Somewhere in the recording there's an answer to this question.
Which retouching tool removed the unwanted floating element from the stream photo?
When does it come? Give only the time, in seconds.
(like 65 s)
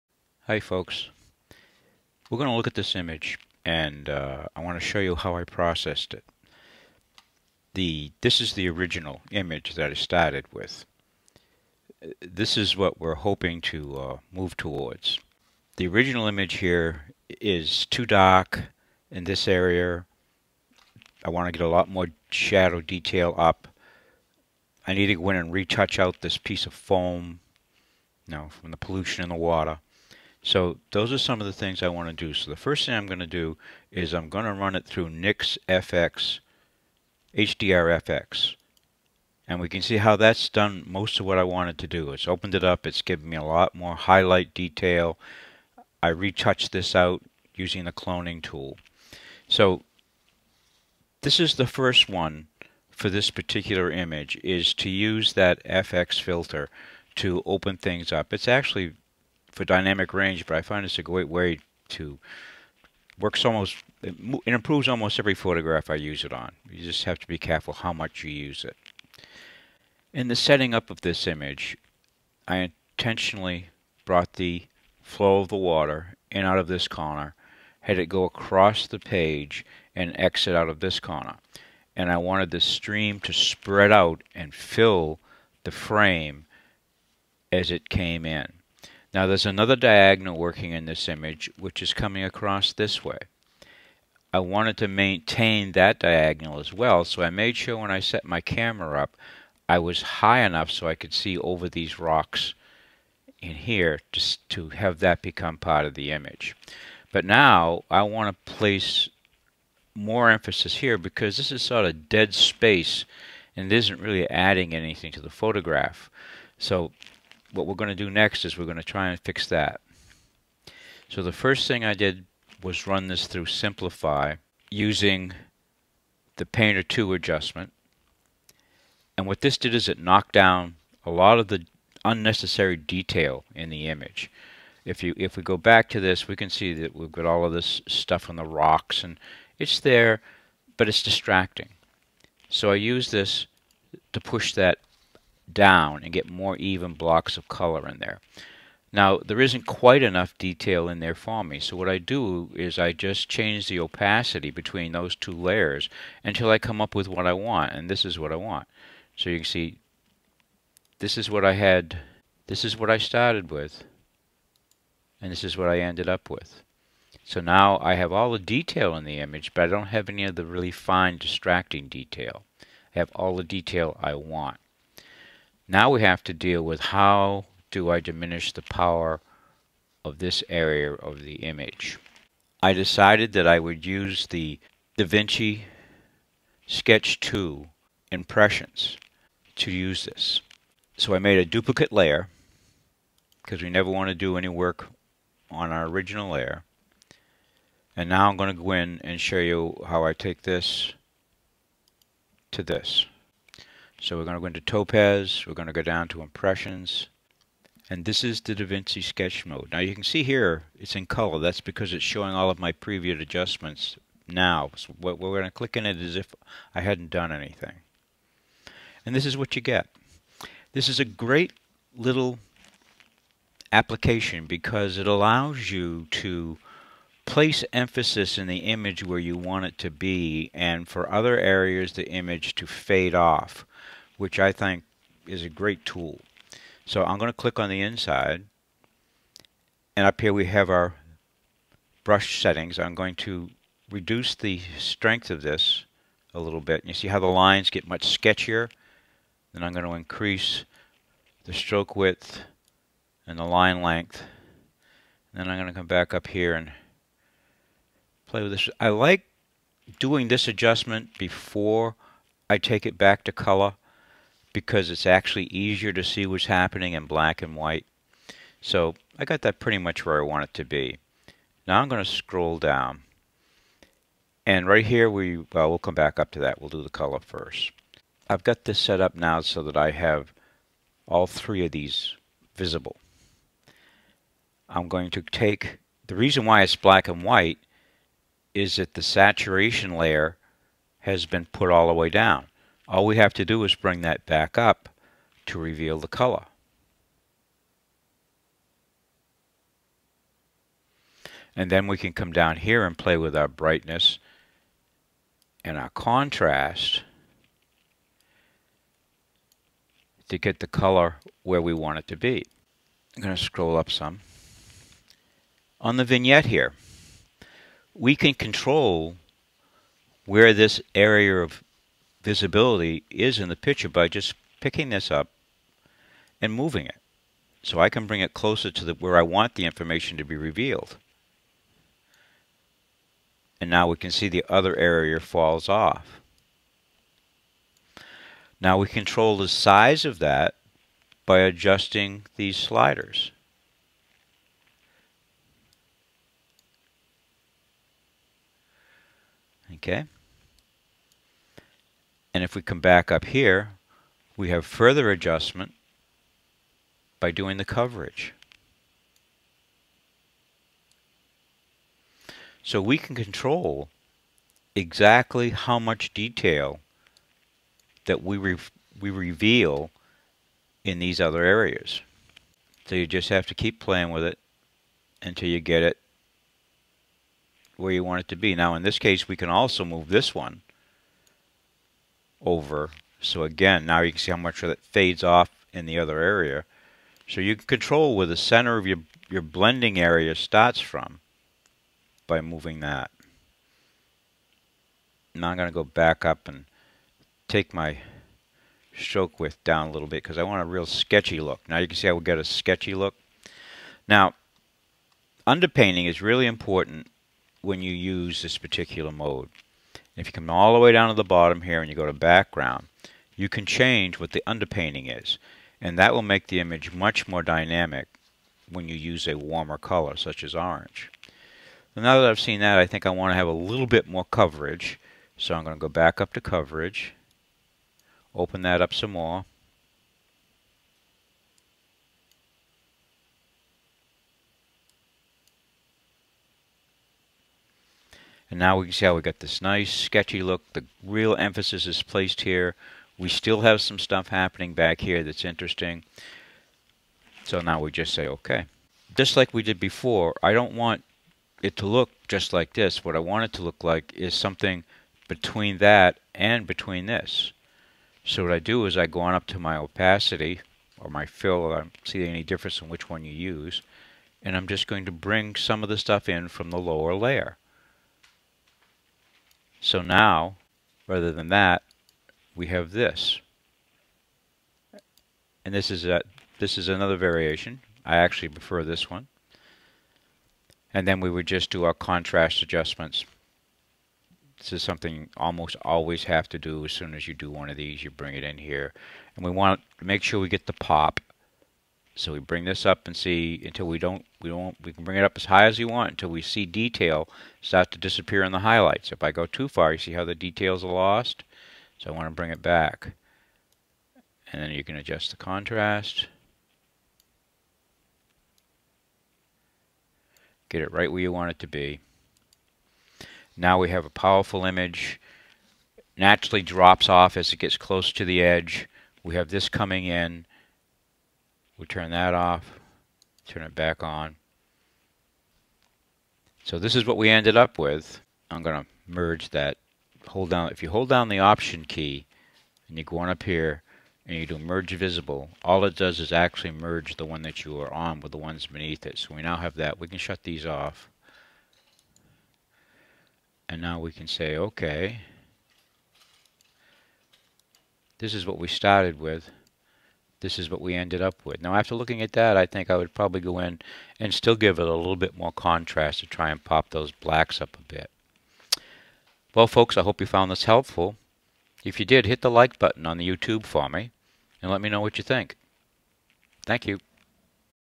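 47 s.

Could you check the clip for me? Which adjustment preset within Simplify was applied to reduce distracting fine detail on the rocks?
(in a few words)
Painter 2.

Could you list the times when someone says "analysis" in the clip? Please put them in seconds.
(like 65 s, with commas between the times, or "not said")
not said.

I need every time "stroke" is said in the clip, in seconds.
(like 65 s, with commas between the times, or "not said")
251 s, 398 s.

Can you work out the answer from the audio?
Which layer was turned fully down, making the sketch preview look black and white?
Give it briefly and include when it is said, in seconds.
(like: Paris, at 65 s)
saturation, at 289 s.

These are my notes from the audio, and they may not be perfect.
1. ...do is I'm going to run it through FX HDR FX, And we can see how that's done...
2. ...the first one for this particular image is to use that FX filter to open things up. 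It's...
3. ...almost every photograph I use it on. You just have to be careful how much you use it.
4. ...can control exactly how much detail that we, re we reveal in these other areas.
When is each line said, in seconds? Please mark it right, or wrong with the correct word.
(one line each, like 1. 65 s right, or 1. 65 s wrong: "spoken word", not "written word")
1. 33 s right
2. 51 s right
3. 64 s right
4. 362 s right.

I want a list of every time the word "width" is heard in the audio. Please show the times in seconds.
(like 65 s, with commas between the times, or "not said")
251 s, 399 s.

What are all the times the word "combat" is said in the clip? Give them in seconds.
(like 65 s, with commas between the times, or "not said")
not said.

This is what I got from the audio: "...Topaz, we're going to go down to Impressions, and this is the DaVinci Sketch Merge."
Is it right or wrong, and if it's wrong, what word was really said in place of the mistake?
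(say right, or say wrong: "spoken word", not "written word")
wrong: "Mode", not "Merge".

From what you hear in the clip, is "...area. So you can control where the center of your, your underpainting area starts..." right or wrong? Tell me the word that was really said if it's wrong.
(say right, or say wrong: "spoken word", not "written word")
wrong: "blending", not "underpainting".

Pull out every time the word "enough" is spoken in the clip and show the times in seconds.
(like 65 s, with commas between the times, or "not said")
100 s, 150 s.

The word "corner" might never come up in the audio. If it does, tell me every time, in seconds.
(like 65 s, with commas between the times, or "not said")
76 s, 80 s.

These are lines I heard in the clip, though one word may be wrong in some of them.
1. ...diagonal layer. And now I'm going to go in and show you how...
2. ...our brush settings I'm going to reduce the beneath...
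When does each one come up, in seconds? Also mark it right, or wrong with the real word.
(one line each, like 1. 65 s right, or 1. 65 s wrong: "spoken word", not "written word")
1. 195 s wrong: "original", not "diagonal"
2. 240 s wrong: "strength", not "beneath".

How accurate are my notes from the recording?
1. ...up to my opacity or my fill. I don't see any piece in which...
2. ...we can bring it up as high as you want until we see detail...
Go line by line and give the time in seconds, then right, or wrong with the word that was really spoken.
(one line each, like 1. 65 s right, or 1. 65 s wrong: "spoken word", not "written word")
1. 459 s wrong: "difference", not "piece"
2. 494 s right.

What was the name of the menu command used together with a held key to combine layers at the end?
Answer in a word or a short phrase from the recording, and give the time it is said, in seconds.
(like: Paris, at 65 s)
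Merge Visible, at 534 s.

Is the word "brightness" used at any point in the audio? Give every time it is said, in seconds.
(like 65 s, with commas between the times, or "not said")
303 s.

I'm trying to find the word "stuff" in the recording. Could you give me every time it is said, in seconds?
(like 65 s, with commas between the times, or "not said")
137 s, 443 s, 465 s.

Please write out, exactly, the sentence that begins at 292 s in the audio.
All we have to do is bring that back up to reveal the color.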